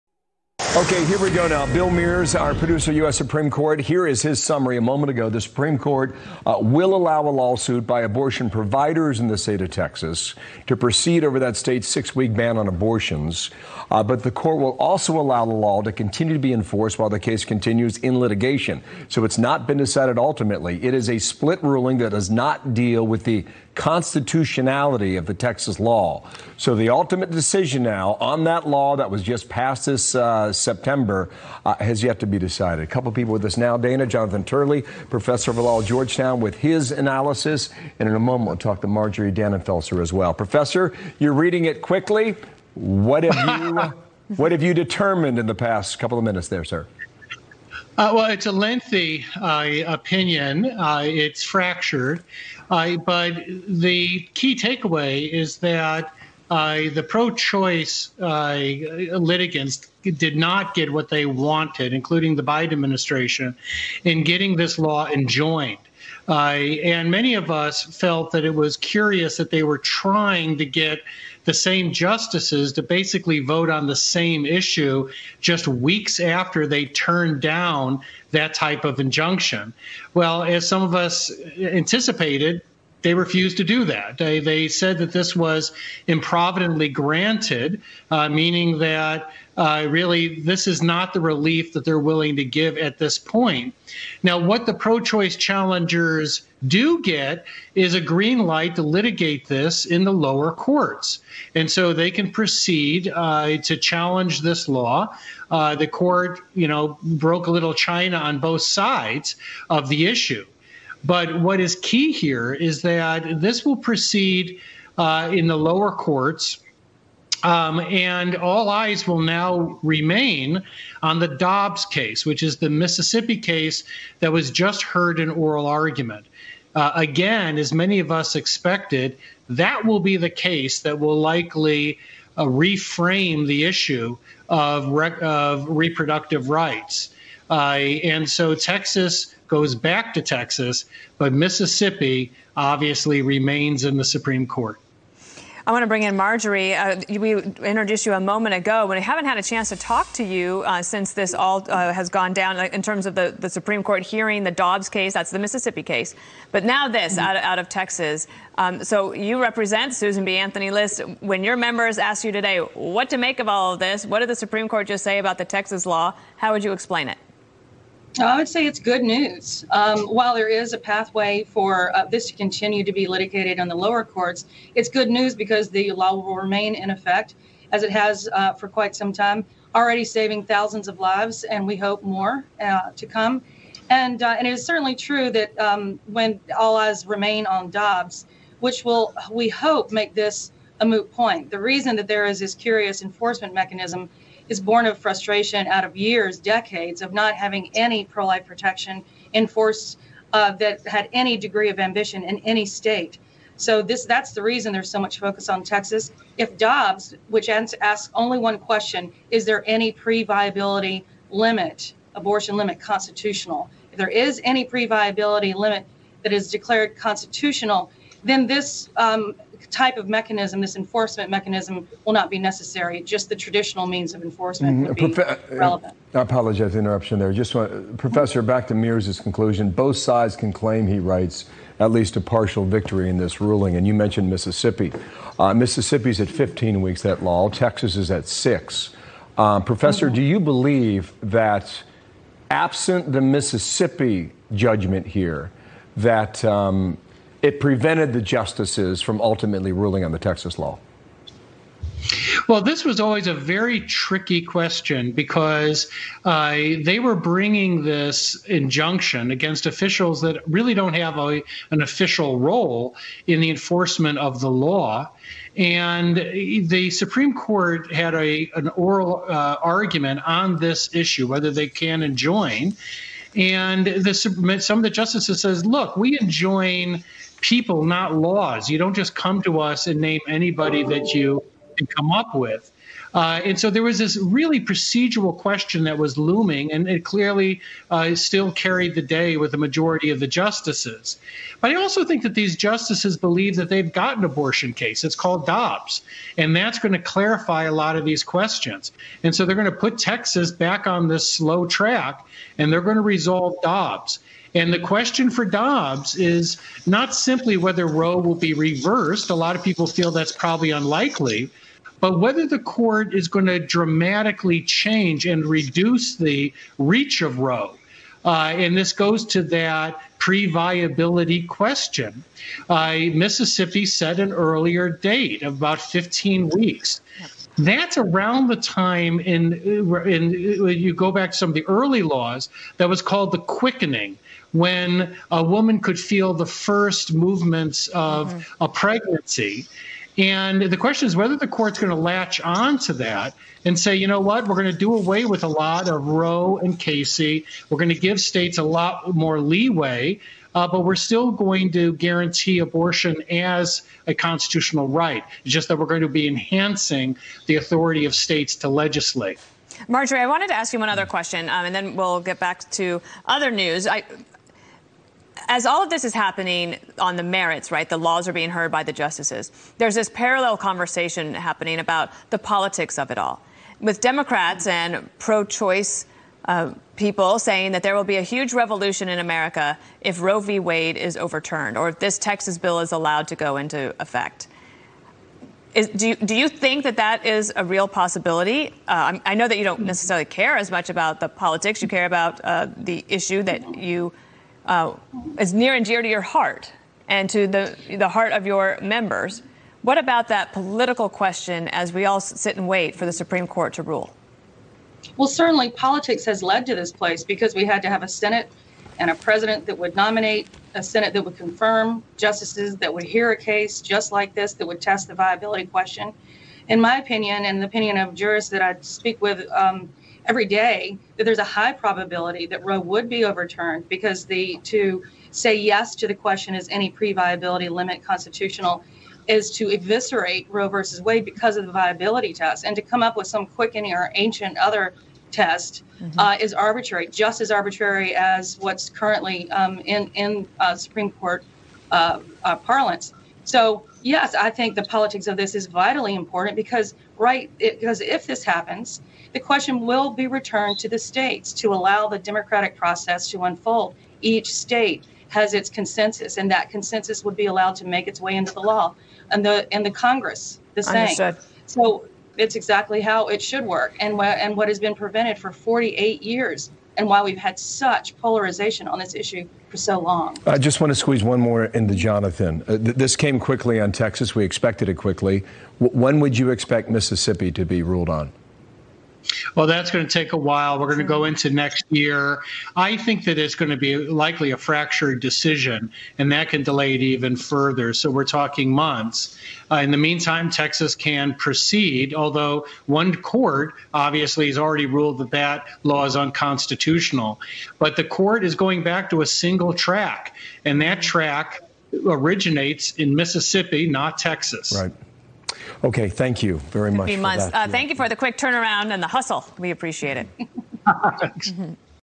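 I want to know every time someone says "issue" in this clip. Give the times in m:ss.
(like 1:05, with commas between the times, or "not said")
1:14, 1:50, 2:13, 4:30, 6:33, 7:49.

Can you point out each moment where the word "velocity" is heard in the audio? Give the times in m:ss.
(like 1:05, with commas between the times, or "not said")
not said.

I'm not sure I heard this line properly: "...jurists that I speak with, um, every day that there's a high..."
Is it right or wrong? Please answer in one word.
right.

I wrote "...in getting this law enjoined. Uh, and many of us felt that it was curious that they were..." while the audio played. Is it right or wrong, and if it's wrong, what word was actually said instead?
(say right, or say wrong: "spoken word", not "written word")
right.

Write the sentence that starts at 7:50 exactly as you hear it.
I just want to squeeze one more into Jonathan.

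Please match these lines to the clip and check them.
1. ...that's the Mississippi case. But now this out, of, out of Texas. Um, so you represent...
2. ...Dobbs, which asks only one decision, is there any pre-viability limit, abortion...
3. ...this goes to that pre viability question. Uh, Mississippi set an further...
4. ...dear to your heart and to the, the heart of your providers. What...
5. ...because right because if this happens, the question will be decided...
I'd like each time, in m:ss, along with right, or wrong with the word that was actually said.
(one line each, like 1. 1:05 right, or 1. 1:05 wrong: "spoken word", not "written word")
1. 2:35 right
2. 3:26 wrong: "question", not "decision"
3. 5:18 wrong: "earlier", not "further"
4. 6:35 wrong: "members", not "providers"
5. 7:26 wrong: "returned", not "decided".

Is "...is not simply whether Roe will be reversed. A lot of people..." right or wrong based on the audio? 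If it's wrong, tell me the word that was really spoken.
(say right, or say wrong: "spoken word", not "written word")
right.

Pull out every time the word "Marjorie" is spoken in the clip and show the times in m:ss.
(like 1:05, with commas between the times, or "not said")
0:38, 2:26, 5:59.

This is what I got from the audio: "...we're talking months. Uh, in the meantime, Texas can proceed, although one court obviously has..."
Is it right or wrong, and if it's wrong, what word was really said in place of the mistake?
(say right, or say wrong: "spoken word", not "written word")
right.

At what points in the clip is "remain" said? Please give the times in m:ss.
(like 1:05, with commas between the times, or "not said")
1:59, 2:23, 2:56, 3:07.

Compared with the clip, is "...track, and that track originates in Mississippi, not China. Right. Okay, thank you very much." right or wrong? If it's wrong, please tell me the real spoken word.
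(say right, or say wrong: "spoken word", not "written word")
wrong: "Texas", not "China".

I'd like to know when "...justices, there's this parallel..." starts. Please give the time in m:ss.
6:08.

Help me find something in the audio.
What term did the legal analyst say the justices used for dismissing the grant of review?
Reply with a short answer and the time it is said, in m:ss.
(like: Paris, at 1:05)
improvidently granted, at 1:26.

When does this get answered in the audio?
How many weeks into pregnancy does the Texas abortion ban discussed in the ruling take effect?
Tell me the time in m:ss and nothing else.
0:11.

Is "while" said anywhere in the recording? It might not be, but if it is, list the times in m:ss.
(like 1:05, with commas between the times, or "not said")
0:16, 2:50, 8:00.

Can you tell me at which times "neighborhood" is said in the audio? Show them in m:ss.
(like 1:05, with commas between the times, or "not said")
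not said.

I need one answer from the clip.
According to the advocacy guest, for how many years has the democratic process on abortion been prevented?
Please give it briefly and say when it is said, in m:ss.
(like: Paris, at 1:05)
48, at 7:45.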